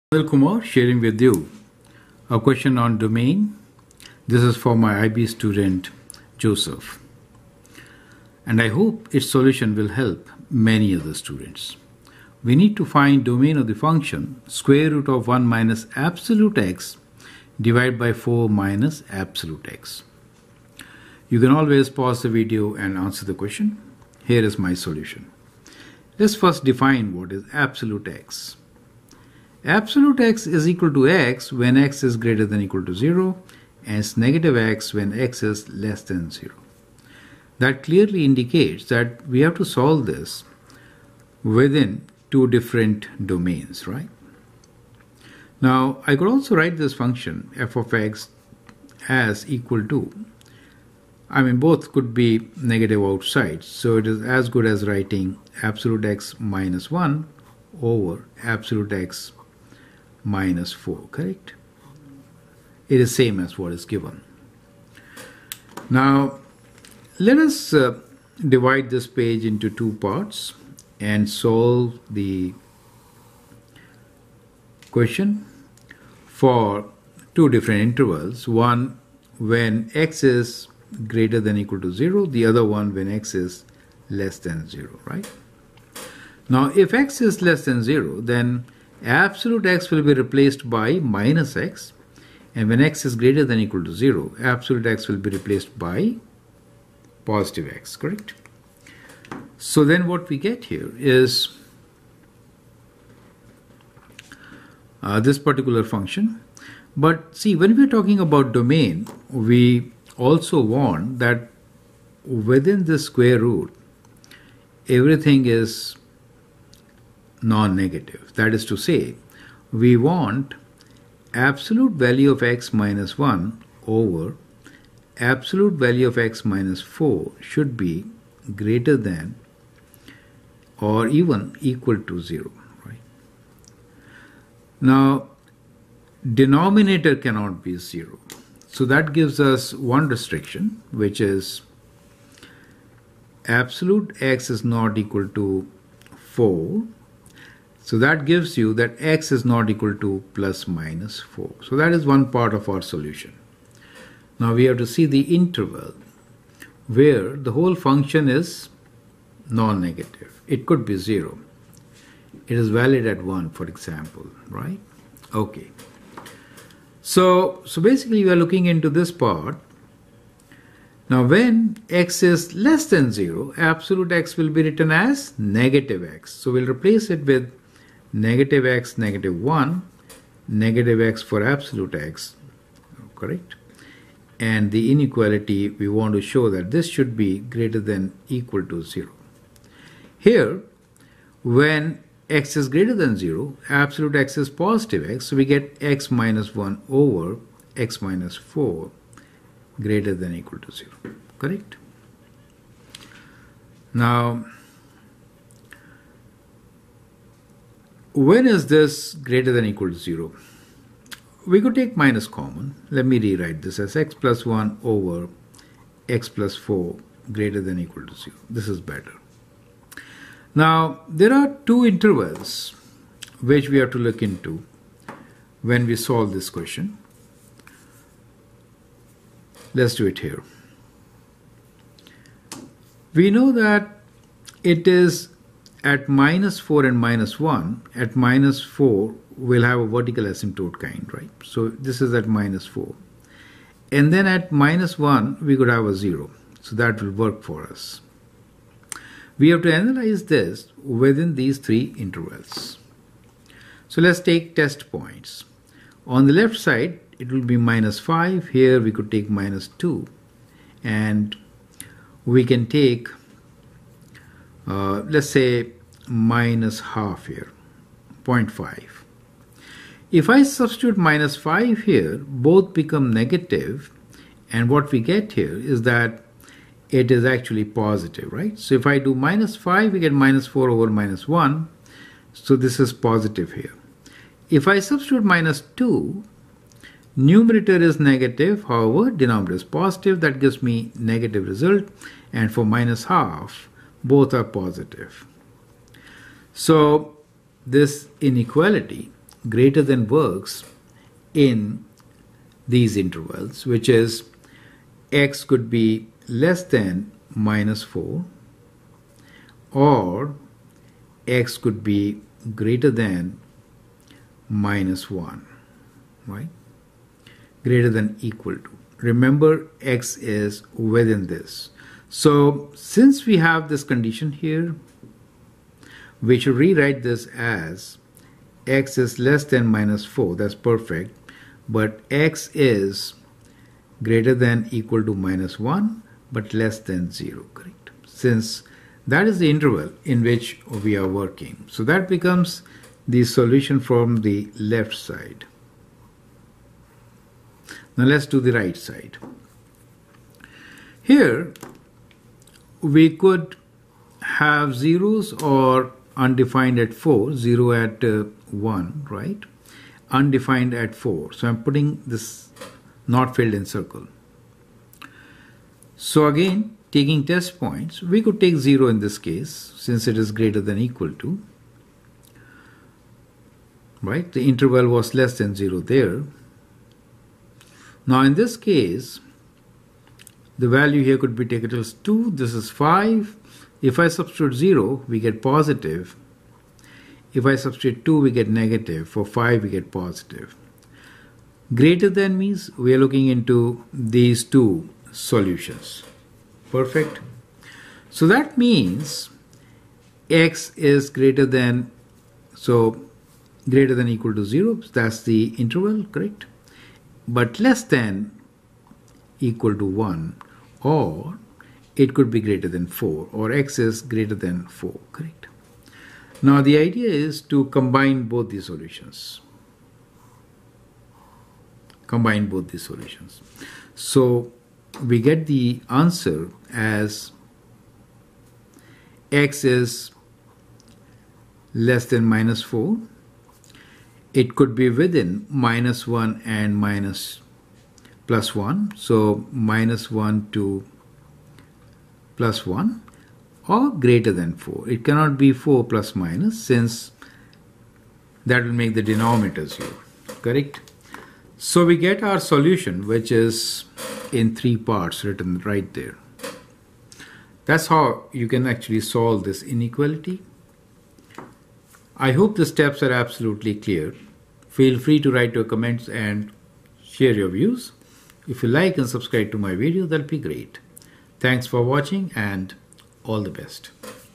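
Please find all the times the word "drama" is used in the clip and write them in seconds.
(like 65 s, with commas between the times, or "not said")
not said.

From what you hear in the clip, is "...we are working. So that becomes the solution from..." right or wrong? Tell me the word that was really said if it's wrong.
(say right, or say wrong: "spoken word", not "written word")
right.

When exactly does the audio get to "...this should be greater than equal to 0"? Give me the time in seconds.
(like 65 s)
186 s.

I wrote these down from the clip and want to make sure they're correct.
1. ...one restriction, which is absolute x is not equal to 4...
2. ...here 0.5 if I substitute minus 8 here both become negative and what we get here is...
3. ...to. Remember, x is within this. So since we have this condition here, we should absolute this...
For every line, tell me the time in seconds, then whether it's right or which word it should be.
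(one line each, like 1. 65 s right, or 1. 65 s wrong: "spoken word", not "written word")
1. 139 s right
2. 267 s wrong: "5", not "8"
3. 318 s wrong: "rewrite", not "absolute".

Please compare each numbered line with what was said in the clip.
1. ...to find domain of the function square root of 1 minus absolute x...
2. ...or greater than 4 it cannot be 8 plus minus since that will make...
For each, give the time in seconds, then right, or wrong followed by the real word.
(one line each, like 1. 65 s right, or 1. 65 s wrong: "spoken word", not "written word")
1. 12 s right
2. 443 s wrong: "4", not "8".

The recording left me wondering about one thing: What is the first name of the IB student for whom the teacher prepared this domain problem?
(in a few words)
Joseph.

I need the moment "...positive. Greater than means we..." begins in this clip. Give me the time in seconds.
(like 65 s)
389 s.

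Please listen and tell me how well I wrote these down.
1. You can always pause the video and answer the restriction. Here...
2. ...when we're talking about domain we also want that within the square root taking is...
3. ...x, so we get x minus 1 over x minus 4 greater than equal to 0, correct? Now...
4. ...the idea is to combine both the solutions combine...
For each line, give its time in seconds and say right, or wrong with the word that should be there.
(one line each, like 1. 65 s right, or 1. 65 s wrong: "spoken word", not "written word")
1. 21 s wrong: "question", not "restriction"
2. 107 s wrong: "everything", not "taking"
3. 195 s right
4. 416 s right.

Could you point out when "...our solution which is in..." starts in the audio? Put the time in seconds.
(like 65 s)
452 s.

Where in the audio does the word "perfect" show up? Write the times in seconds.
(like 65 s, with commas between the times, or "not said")
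330 s, 396 s.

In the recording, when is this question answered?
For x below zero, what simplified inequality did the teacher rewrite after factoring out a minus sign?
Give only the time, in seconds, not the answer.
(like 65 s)
213 s.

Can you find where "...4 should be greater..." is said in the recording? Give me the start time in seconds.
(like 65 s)
126 s.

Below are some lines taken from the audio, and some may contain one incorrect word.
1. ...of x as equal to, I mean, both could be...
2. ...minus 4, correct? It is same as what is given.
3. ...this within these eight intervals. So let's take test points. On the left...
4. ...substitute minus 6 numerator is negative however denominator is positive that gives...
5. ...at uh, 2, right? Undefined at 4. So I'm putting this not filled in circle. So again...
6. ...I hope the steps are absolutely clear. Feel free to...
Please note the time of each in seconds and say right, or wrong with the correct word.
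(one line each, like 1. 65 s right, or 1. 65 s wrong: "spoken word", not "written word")
1. 47 s right
2. 60 s right
3. 250 s wrong: "three", not "eight"
4. 284 s wrong: "2", not "6"
5. 357 s wrong: "1", not "2"
6. 462 s right.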